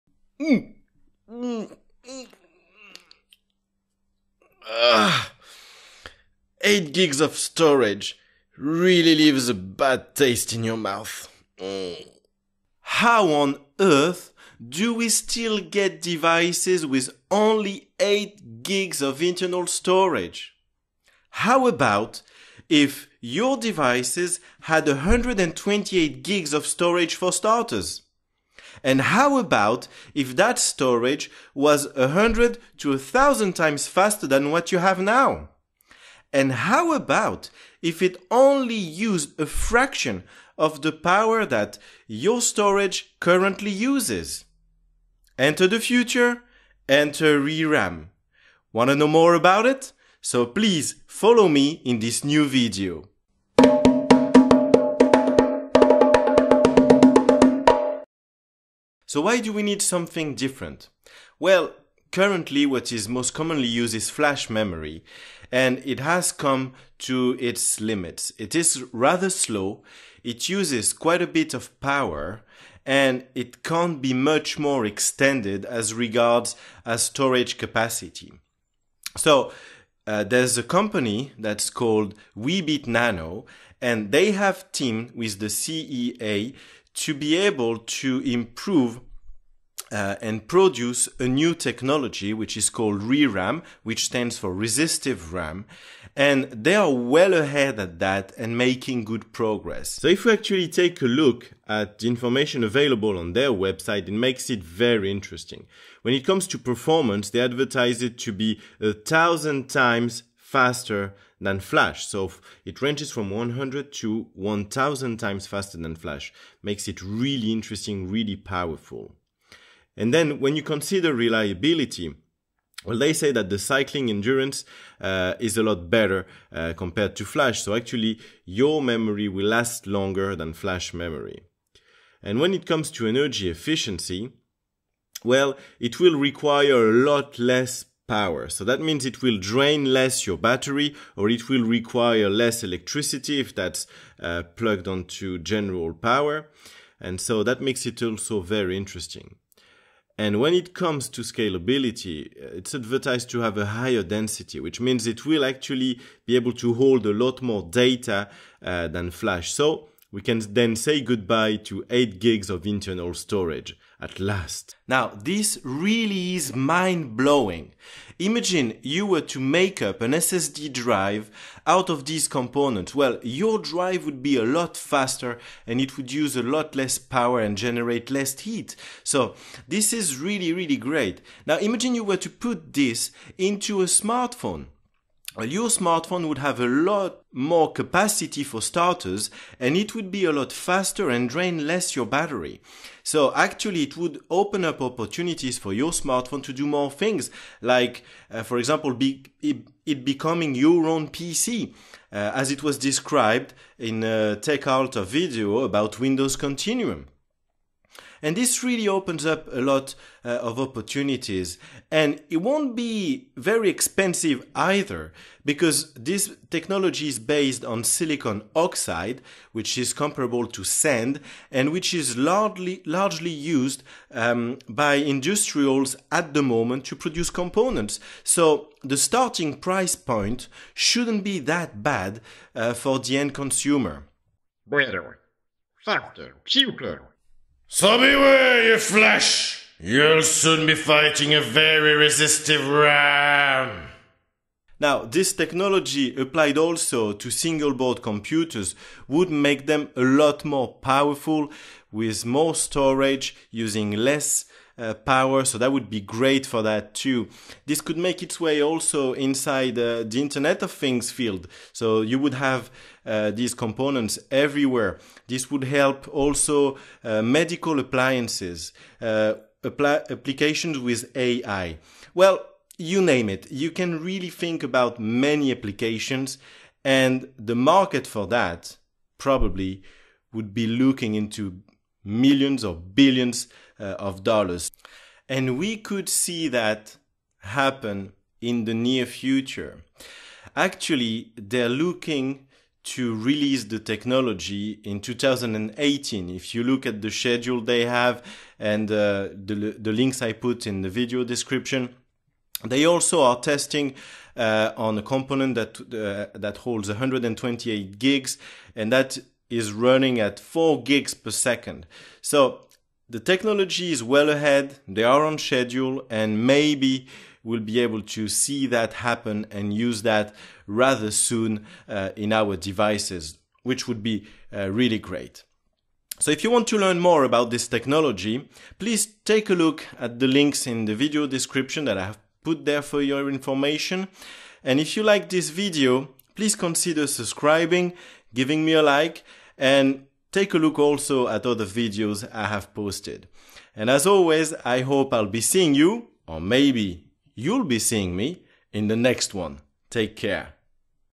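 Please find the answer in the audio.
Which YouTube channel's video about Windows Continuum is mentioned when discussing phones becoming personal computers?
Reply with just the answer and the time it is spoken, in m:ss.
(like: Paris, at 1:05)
TechAltar, at 3:24.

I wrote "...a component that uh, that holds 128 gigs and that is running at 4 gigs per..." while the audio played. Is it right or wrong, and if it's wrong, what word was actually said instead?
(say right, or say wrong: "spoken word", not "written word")
right.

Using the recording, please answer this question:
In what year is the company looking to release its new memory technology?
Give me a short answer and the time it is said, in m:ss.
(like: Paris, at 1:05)
2018, at 4:54.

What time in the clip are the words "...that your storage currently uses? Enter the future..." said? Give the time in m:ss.
0:41.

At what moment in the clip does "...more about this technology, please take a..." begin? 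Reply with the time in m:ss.
5:27.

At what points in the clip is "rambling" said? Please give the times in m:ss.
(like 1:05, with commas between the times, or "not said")
not said.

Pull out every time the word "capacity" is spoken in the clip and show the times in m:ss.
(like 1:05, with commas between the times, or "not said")
1:17, 3:07.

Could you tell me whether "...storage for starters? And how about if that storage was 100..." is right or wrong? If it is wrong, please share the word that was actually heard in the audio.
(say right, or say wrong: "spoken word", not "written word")
right.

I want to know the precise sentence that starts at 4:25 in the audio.
This would help also uh, medical appliances, uh, apply- applications with AI.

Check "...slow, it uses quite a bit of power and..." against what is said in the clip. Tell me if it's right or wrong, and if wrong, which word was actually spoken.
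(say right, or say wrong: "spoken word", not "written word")
right.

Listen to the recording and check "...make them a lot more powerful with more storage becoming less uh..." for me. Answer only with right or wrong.
wrong.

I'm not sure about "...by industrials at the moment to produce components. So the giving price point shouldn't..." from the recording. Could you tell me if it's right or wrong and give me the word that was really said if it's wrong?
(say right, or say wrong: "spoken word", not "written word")
wrong: "starting", not "giving".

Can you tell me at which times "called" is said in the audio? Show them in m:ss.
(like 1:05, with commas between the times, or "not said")
1:21, 1:32.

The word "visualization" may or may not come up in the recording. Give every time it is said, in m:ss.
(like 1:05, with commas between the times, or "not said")
not said.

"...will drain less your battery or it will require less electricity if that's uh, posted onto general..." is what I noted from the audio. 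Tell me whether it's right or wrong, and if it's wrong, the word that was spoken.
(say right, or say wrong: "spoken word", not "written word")
wrong: "plugged", not "posted".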